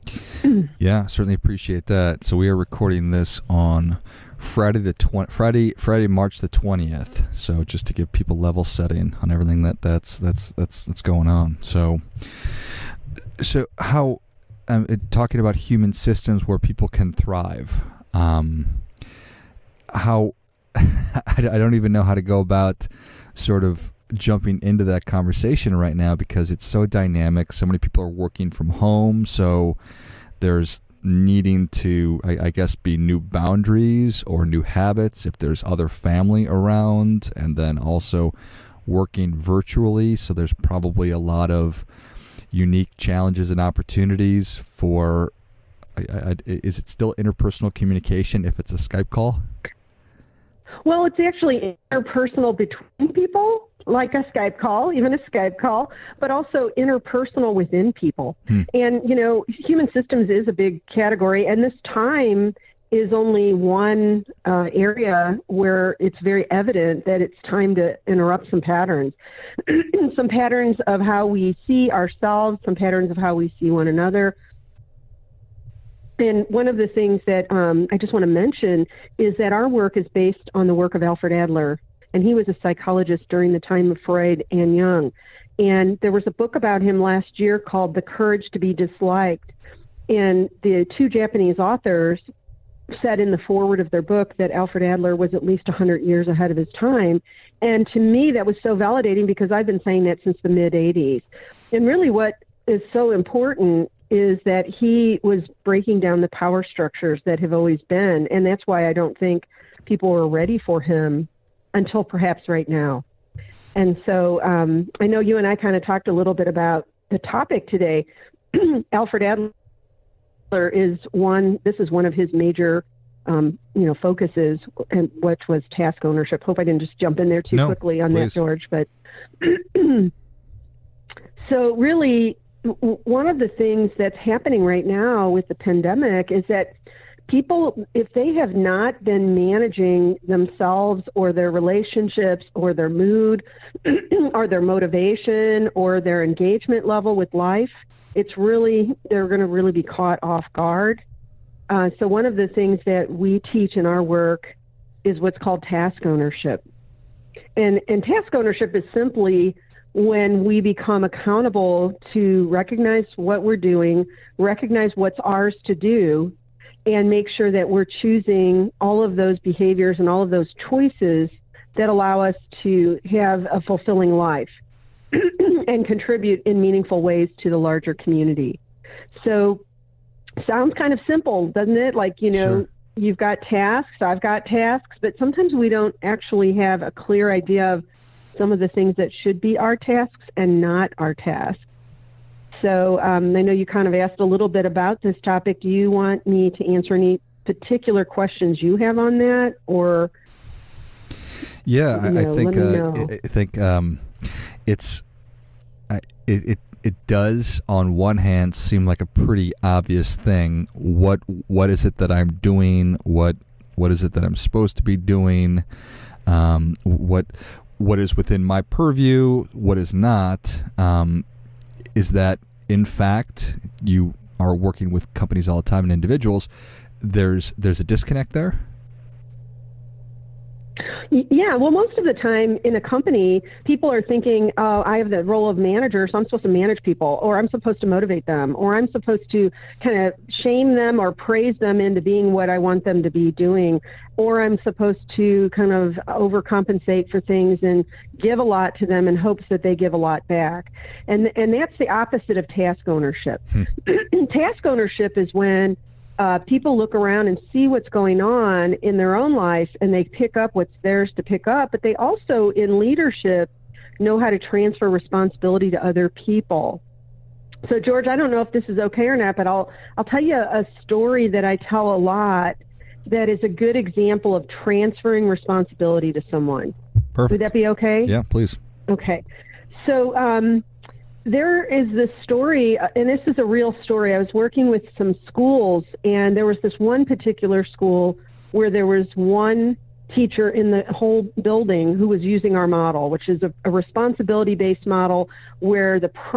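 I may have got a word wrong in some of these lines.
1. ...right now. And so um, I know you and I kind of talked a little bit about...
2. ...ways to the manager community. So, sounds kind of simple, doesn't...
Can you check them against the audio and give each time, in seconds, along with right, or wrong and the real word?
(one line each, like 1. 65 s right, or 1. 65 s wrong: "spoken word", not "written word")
1. 112 s right
2. 177 s wrong: "larger", not "manager".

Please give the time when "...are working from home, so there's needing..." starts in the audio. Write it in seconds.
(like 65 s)
28 s.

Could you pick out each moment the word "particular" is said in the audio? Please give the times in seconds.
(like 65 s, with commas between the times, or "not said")
197 s, 287 s.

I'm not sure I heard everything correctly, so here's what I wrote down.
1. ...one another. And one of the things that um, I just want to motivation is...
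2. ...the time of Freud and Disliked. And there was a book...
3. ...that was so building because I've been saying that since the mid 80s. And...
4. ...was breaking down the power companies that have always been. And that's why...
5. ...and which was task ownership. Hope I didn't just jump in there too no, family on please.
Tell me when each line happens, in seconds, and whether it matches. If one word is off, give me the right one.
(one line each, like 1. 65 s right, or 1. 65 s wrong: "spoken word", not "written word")
1. 73 s wrong: "mention", not "motivation"
2. 83 s wrong: "Jung", not "Disliked"
3. 98 s wrong: "validating", not "building"
4. 105 s wrong: "structures", not "companies"
5. 124 s wrong: "quickly", not "family".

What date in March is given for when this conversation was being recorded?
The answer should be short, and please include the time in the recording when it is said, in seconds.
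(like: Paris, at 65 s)
March 20, at 6 s.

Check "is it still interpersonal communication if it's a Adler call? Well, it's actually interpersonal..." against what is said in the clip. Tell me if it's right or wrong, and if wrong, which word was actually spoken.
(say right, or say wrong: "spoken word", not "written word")
wrong: "Skype", not "Adler".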